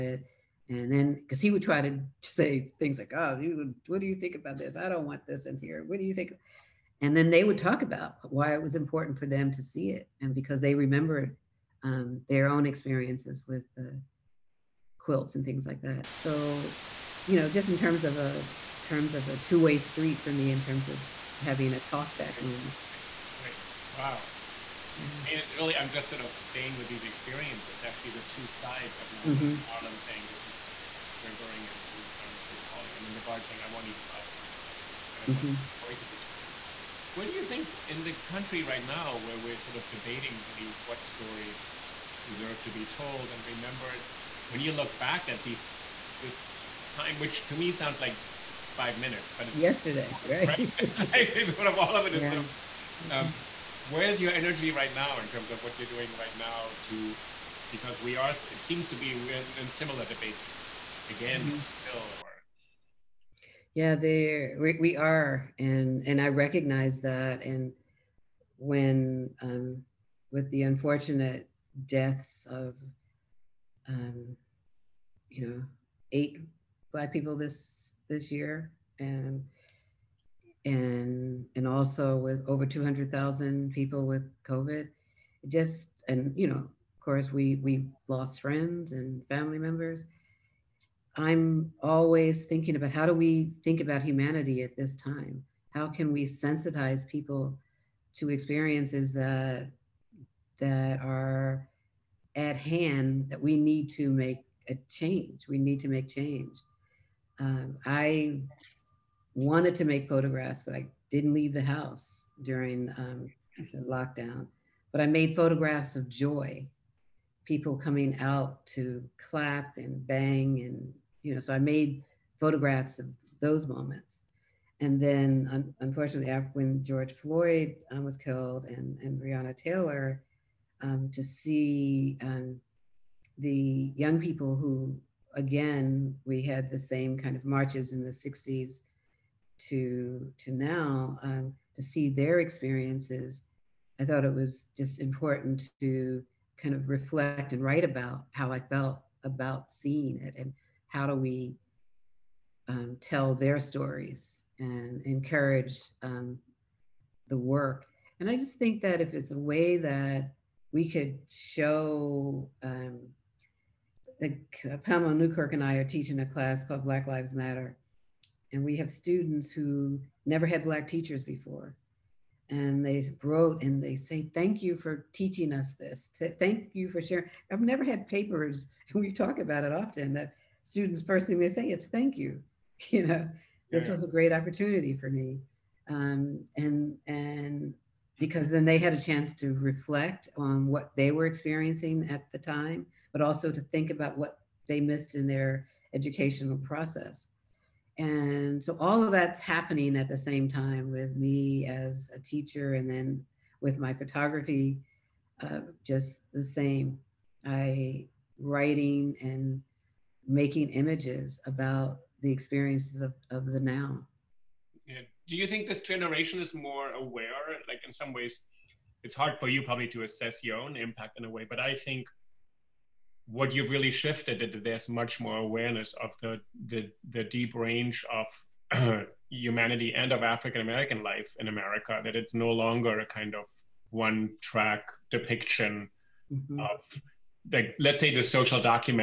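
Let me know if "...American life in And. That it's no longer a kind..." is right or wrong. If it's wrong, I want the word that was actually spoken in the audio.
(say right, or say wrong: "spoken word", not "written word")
wrong: "America", not "And".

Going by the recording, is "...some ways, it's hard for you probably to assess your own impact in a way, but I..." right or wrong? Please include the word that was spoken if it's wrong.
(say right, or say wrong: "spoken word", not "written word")
right.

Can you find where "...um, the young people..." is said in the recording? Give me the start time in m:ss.
2:12.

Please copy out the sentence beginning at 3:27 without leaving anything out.
I writing and making images about the experiences of, of the now.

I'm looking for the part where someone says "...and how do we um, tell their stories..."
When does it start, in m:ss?
2:30.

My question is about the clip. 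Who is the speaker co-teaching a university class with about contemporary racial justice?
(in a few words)
Pamela Newkirk.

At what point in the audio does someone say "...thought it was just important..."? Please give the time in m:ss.
2:24.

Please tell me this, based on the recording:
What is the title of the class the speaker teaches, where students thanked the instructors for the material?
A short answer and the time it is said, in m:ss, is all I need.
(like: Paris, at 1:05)
Black Lives Matter, at 2:46.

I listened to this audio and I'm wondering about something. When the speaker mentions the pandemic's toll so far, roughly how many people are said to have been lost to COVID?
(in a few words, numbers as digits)
200,000.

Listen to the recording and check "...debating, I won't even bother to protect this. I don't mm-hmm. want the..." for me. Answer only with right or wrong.
wrong.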